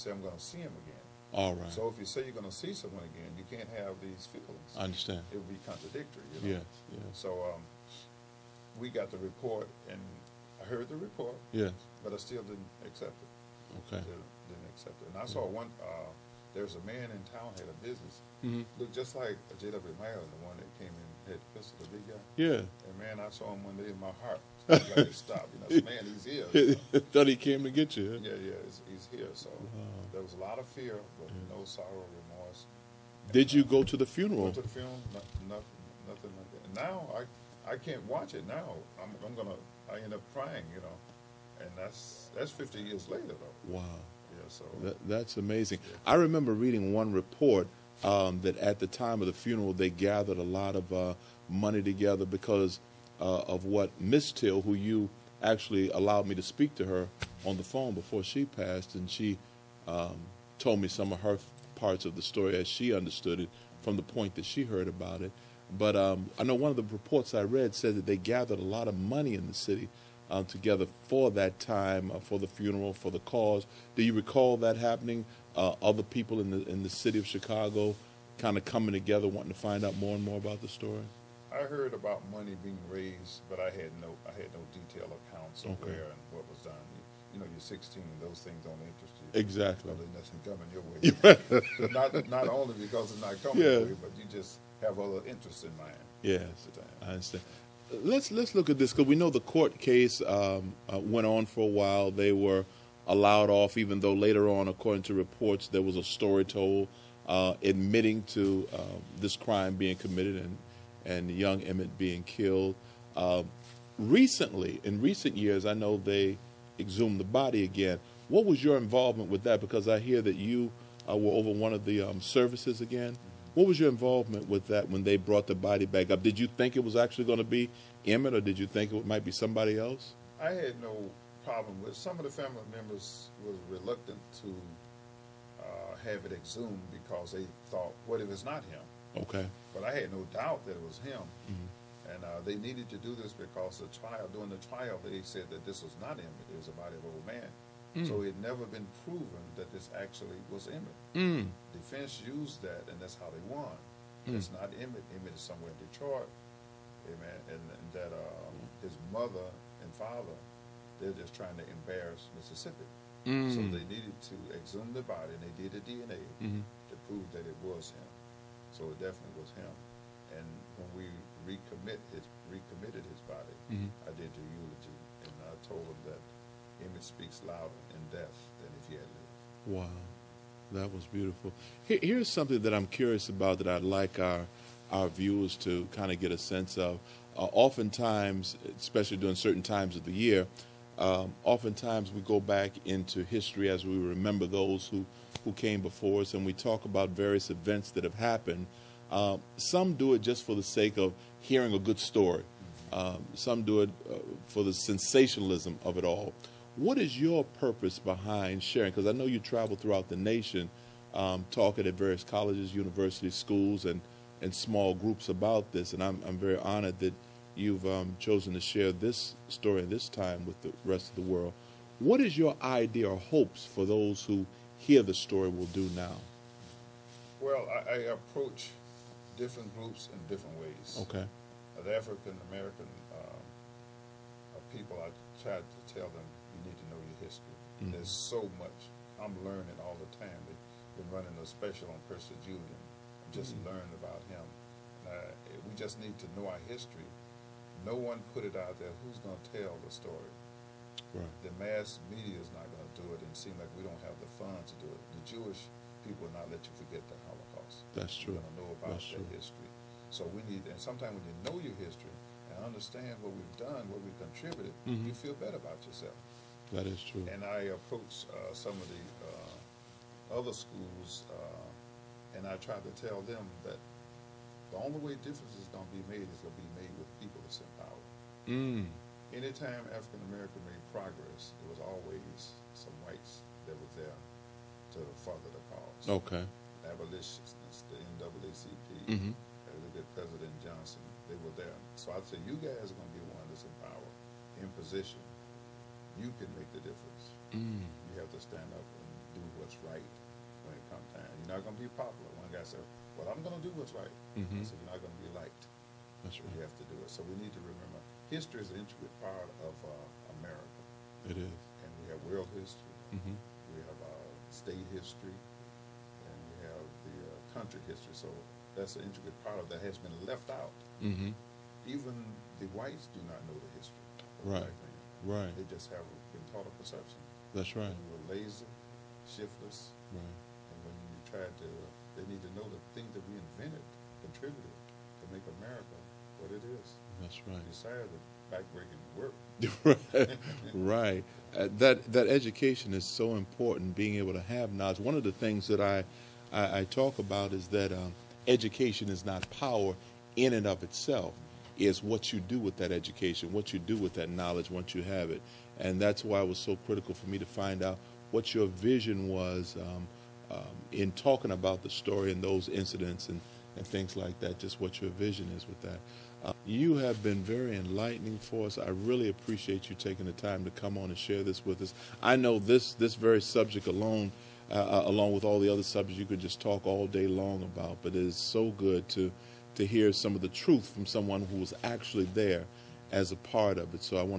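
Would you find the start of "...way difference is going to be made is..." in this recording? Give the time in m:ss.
4:35.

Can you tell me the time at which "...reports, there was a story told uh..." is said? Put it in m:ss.
1:45.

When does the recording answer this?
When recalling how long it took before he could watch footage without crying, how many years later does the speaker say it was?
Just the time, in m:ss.
0:42.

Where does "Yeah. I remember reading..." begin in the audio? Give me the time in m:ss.
0:45.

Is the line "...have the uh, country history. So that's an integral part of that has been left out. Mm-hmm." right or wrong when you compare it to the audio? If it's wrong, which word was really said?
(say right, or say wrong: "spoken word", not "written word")
right.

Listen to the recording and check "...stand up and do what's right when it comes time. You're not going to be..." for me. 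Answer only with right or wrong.
right.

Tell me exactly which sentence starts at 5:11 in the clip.
It is, and we have world history.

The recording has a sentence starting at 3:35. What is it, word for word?
And I'm I'm very honored that you've um, chosen to share this story this time with the rest of the world.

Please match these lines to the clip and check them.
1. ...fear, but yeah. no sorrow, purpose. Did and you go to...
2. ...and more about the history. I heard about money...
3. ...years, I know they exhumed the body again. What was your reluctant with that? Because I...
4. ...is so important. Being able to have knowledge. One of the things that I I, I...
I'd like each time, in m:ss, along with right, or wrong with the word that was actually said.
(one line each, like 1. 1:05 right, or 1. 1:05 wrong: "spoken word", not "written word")
1. 0:30 wrong: "remorse", not "purpose"
2. 1:20 wrong: "story", not "history"
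3. 1:55 wrong: "involvement", not "reluctant"
4. 5:42 right.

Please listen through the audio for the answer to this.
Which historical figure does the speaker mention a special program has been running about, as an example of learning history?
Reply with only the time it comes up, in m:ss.
4:02.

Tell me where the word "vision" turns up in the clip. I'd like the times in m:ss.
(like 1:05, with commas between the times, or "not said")
5:58, 6:05.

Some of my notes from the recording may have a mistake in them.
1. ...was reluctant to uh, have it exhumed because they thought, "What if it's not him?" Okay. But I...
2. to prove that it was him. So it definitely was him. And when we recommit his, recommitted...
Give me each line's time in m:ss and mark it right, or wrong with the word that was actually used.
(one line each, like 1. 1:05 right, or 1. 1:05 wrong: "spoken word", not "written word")
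1. 2:13 right
2. 2:46 right.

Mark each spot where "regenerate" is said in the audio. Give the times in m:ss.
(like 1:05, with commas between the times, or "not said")
not said.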